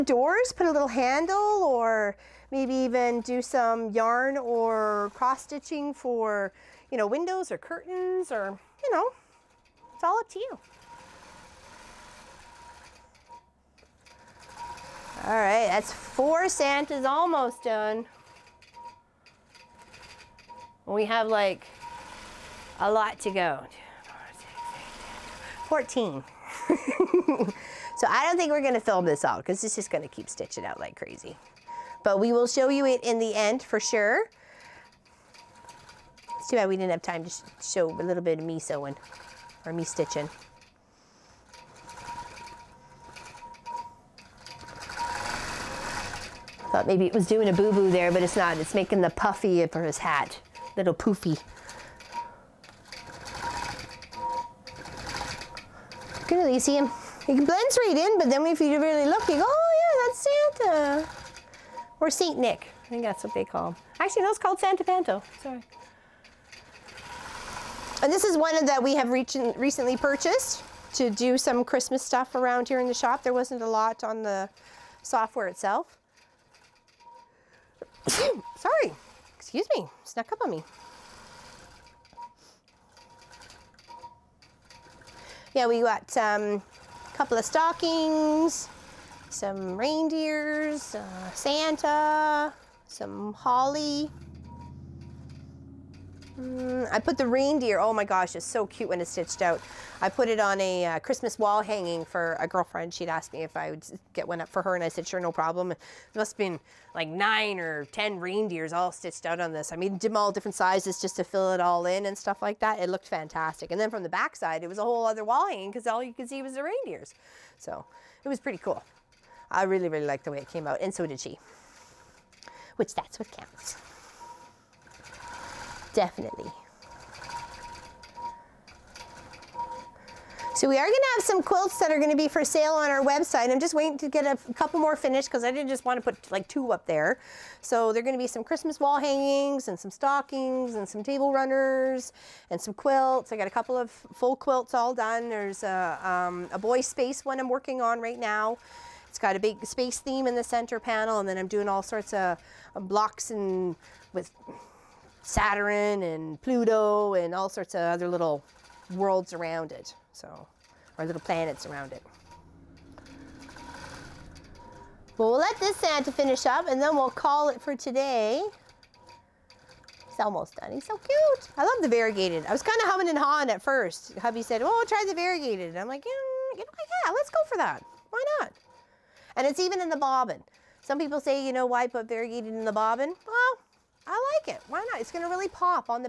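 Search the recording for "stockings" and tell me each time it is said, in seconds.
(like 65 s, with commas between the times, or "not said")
87 s, 139 s.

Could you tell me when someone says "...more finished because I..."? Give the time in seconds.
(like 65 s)
134 s.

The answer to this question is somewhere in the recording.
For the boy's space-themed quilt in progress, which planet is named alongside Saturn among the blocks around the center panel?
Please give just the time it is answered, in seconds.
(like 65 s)
156 s.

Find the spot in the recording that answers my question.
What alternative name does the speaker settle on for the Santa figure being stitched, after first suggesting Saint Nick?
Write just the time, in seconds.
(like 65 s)
64 s.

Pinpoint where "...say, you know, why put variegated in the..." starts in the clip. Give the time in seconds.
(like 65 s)
181 s.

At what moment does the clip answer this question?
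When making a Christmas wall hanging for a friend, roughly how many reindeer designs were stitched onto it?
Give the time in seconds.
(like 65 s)
107 s.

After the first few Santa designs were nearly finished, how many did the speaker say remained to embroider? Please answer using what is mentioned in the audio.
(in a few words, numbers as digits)
14.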